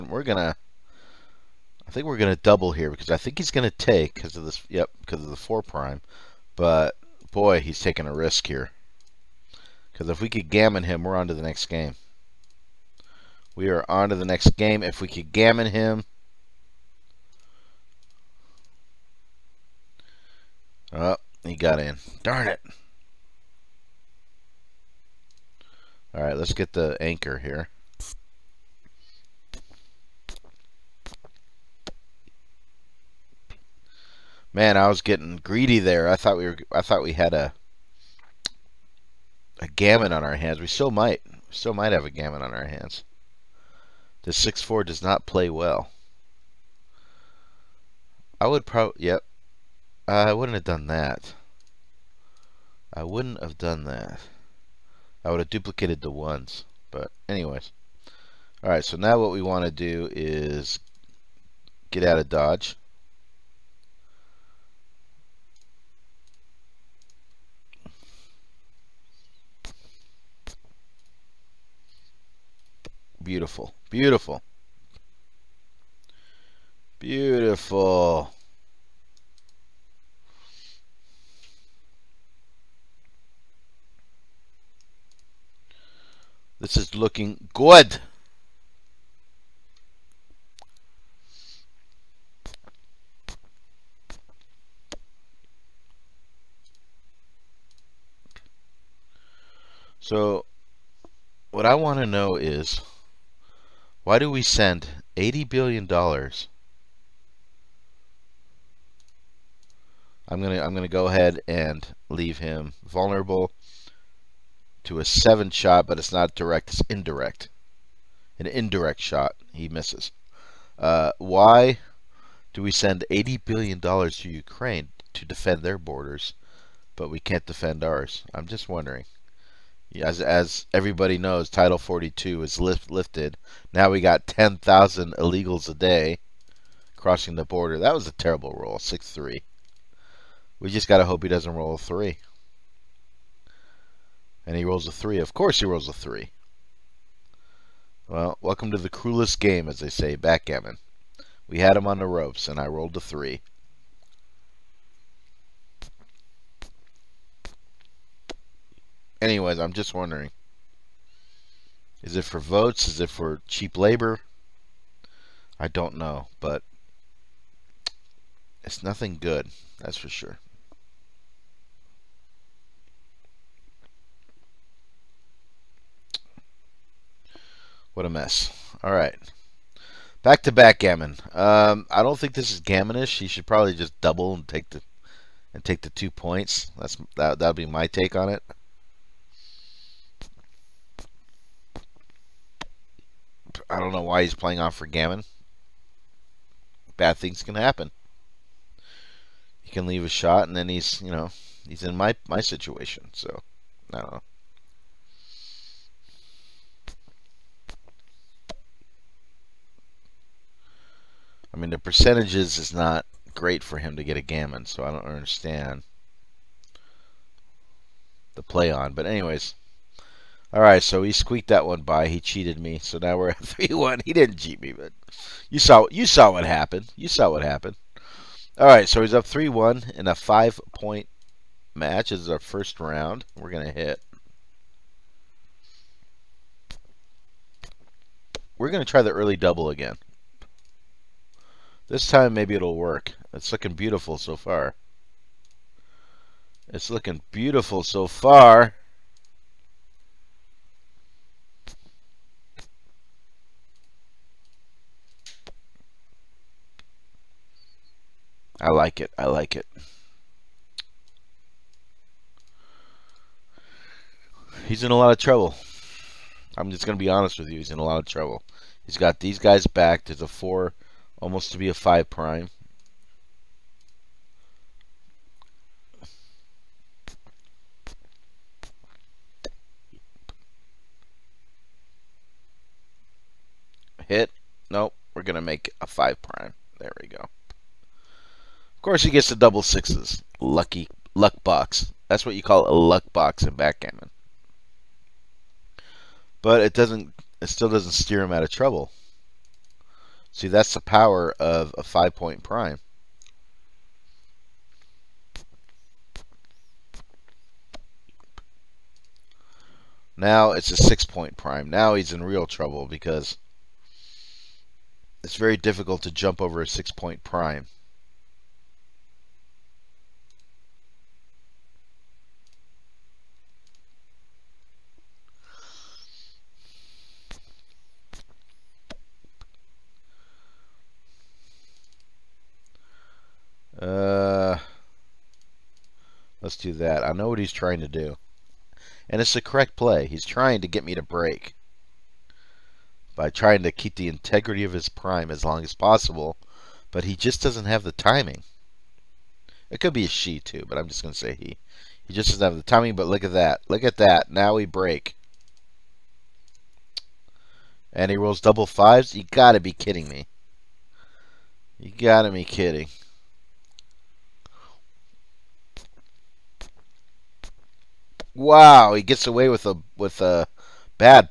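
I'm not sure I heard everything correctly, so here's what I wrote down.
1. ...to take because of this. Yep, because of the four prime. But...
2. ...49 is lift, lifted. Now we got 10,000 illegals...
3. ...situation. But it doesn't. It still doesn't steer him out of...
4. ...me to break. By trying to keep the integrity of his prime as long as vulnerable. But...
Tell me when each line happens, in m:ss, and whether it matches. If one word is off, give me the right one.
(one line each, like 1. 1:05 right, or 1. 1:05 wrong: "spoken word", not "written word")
1. 0:03 right
2. 2:11 wrong: "42", not "49"
3. 4:53 wrong: "backgammon", not "situation"
4. 5:40 wrong: "possible", not "vulnerable".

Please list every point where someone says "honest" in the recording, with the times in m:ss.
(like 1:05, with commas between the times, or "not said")
4:27.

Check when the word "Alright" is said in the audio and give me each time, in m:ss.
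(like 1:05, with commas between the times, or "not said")
0:26, 0:58.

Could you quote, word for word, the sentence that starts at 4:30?
There's a four almost to be a 5 prime.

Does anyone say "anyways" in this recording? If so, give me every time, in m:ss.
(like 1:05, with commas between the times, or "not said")
0:57, 2:39, 3:39.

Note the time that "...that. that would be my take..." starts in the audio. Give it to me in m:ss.
3:07.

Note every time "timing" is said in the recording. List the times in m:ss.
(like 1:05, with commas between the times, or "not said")
5:47, 5:52.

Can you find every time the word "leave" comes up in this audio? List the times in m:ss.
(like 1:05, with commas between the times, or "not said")
1:52, 3:19.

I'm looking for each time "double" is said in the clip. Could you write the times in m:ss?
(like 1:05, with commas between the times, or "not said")
0:02, 3:04, 3:59, 4:49, 5:58.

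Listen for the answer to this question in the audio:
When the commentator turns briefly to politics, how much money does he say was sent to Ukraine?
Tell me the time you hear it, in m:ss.
1:45.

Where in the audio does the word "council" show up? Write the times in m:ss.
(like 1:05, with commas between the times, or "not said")
not said.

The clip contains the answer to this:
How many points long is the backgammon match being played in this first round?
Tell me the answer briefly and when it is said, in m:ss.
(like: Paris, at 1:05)
5, at 3:50.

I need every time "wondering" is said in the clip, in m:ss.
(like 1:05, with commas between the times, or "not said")
2:08, 2:39.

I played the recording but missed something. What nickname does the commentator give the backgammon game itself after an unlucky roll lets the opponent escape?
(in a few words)
the cruelest game.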